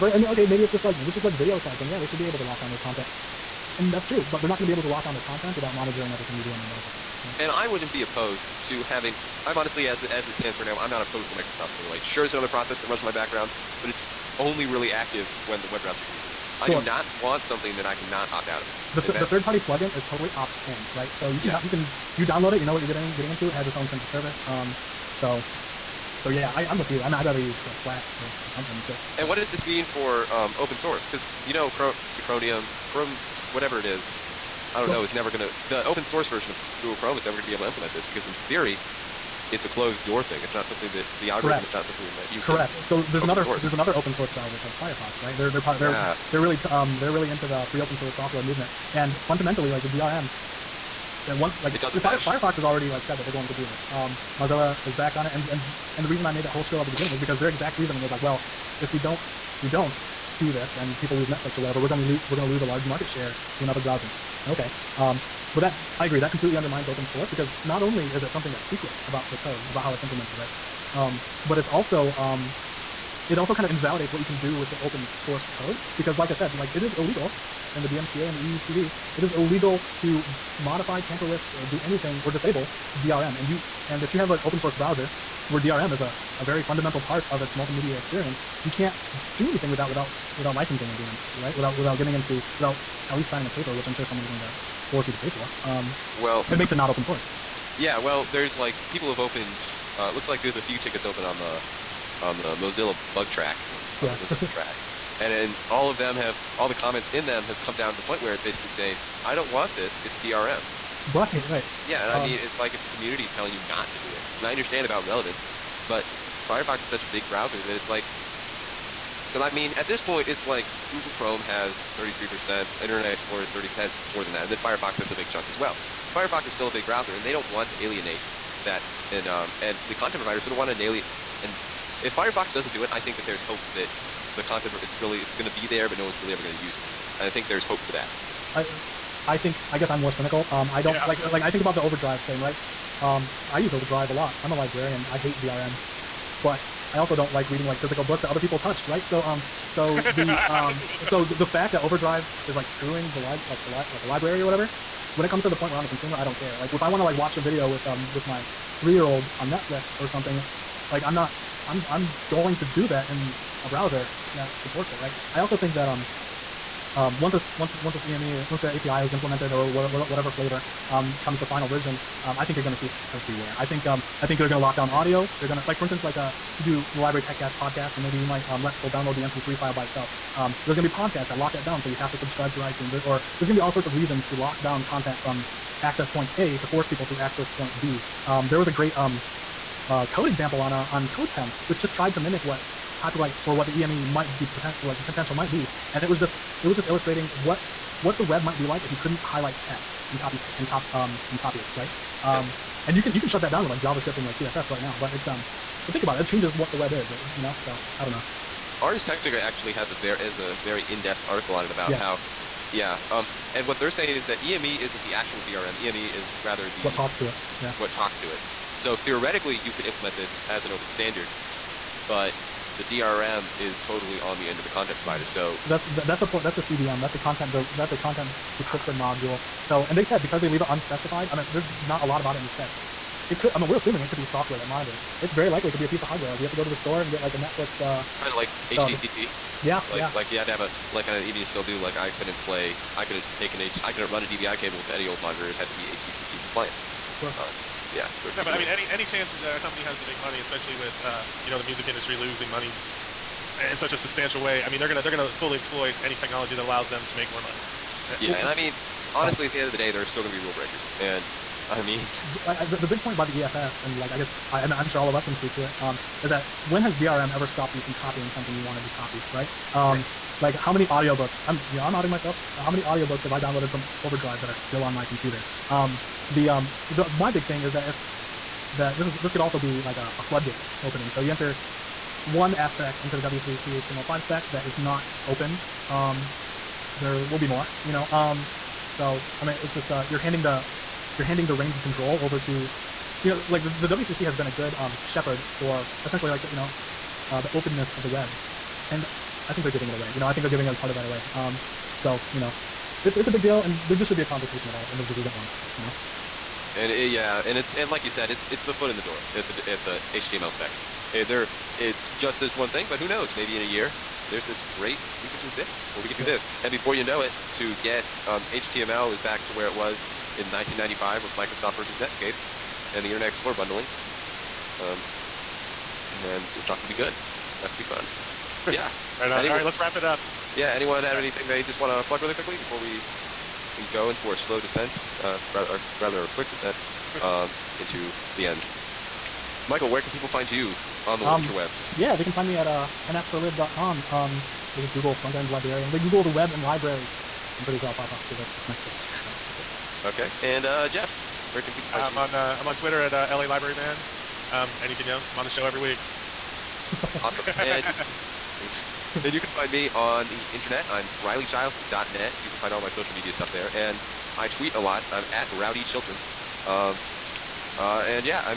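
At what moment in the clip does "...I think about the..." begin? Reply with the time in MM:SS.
02:21.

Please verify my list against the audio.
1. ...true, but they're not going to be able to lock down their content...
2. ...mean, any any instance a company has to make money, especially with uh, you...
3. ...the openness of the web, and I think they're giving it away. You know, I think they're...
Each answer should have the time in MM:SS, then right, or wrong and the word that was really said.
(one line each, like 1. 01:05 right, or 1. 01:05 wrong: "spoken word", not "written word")
1. 00:04 right
2. 04:08 wrong: "chance", not "instance"
3. 04:57 right.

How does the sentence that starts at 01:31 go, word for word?
Without without getting into without at least signing a paper, which I'm sure someone's going to force you to pay for.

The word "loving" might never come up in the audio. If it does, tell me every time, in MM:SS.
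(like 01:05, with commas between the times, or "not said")
not said.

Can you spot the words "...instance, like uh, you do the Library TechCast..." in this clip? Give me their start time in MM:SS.
02:55.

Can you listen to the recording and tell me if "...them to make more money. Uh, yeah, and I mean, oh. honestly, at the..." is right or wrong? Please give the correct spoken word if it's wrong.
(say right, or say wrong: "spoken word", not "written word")
right.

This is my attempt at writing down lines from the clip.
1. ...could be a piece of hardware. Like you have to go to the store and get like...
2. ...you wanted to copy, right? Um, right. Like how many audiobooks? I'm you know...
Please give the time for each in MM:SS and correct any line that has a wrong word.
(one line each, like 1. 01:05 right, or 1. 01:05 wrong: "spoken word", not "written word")
1. 03:55 right
2. 04:28 right.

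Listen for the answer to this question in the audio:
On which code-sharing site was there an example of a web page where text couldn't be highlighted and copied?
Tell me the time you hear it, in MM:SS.
03:11.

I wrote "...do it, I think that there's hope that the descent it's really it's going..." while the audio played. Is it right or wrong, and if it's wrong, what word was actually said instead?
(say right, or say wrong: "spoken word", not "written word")
wrong: "content", not "descent".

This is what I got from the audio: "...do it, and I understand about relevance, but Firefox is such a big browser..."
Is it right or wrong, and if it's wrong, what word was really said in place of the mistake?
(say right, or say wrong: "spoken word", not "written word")
right.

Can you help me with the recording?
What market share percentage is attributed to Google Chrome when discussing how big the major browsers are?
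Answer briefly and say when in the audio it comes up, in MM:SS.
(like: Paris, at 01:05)
33%, at 02:01.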